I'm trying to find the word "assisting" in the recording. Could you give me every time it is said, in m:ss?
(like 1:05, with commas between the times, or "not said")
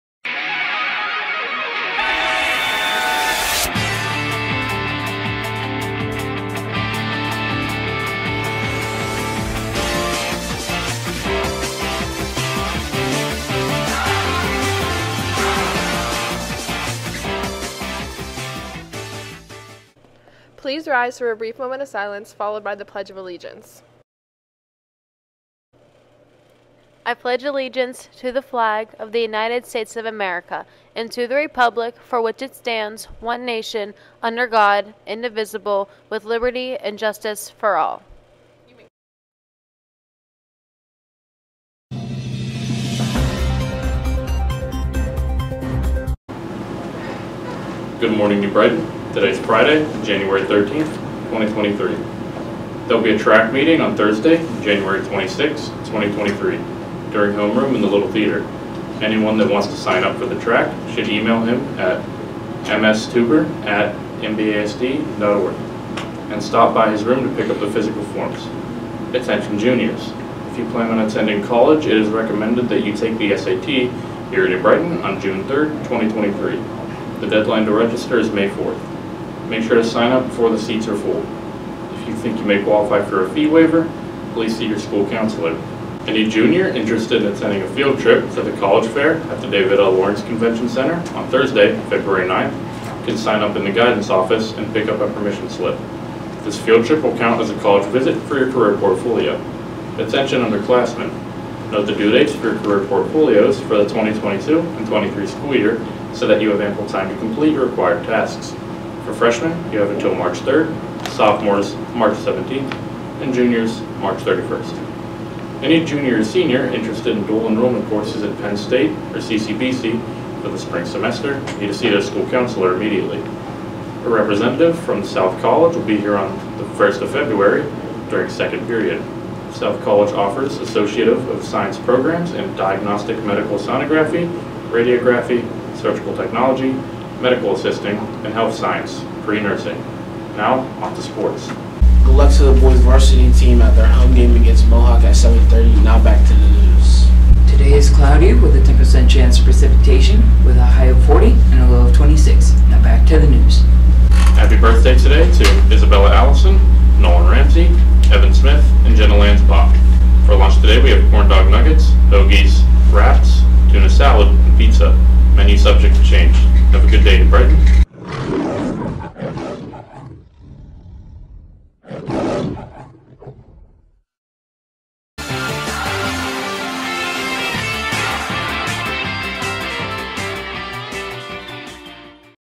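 2:17.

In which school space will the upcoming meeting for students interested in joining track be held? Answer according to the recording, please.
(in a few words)
Little Theater.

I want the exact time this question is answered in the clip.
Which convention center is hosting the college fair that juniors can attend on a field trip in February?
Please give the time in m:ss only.
1:29.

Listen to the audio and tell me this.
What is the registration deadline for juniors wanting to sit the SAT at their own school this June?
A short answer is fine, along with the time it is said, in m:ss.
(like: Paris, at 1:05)
May 4, at 1:18.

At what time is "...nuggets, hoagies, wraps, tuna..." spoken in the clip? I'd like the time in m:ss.
2:41.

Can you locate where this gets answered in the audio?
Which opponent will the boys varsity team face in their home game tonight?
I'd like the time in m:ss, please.
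2:24.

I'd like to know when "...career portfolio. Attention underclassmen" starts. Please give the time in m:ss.
1:38.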